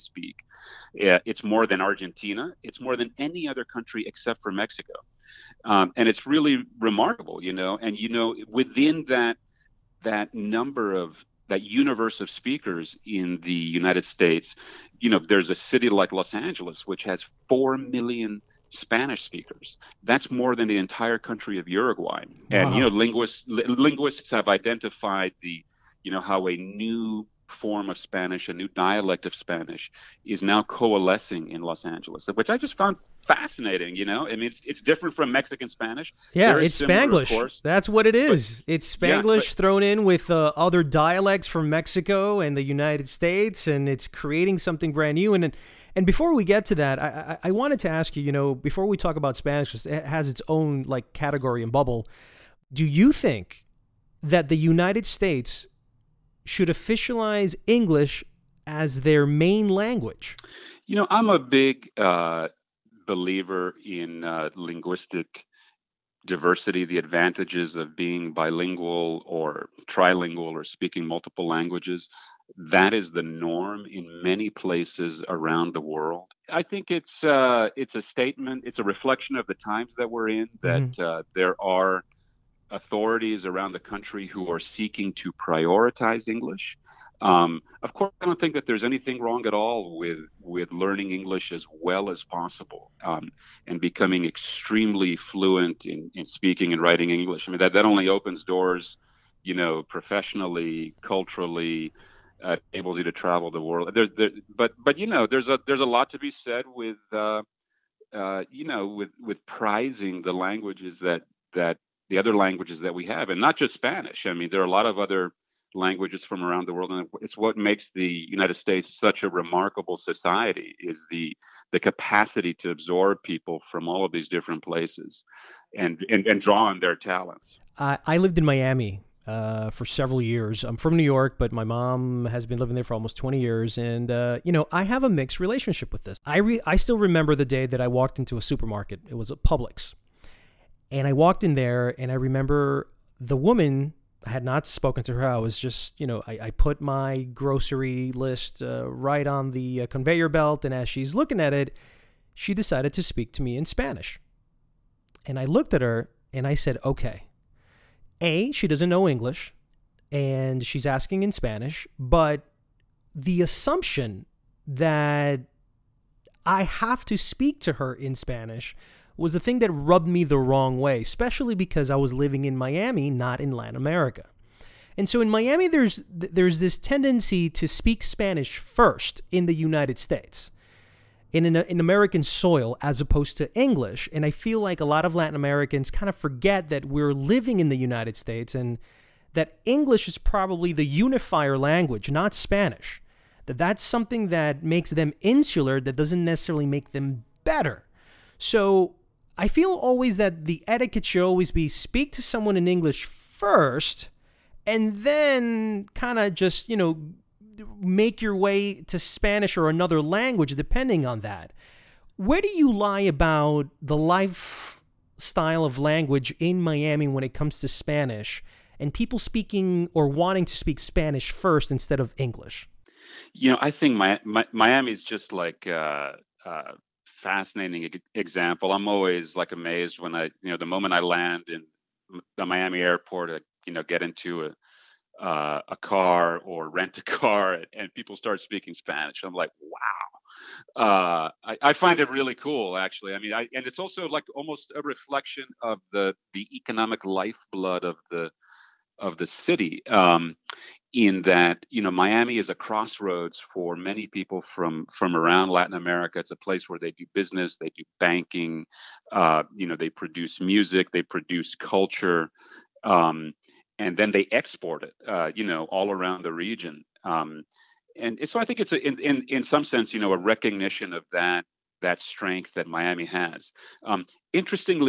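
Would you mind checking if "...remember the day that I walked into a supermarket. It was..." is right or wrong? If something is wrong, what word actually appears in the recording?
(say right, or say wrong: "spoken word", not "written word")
right.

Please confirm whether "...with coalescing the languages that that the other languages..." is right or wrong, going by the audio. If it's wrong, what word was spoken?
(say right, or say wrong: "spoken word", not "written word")
wrong: "prizing", not "coalescing".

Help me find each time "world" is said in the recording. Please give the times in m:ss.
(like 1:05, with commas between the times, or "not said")
1:15, 1:43, 1:56.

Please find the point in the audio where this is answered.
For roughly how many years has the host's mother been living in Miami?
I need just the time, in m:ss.
2:13.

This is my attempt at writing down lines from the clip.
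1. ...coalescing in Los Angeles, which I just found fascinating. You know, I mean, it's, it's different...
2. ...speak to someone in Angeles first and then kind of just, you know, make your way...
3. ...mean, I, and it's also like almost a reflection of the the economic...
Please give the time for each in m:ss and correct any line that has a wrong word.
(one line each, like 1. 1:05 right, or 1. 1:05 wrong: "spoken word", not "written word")
1. 0:30 right
2. 3:21 wrong: "English", not "Angeles"
3. 4:03 right.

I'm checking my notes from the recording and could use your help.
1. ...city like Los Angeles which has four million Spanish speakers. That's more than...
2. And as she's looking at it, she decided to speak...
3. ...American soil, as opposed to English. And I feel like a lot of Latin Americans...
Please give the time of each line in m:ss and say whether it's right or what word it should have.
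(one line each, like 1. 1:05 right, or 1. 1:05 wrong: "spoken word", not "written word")
1. 0:15 right
2. 2:30 right
3. 3:01 right.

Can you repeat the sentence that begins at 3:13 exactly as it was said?
That that's something that makes them insular, that doesn't necessarily make them better.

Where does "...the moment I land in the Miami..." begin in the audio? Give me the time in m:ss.
3:50.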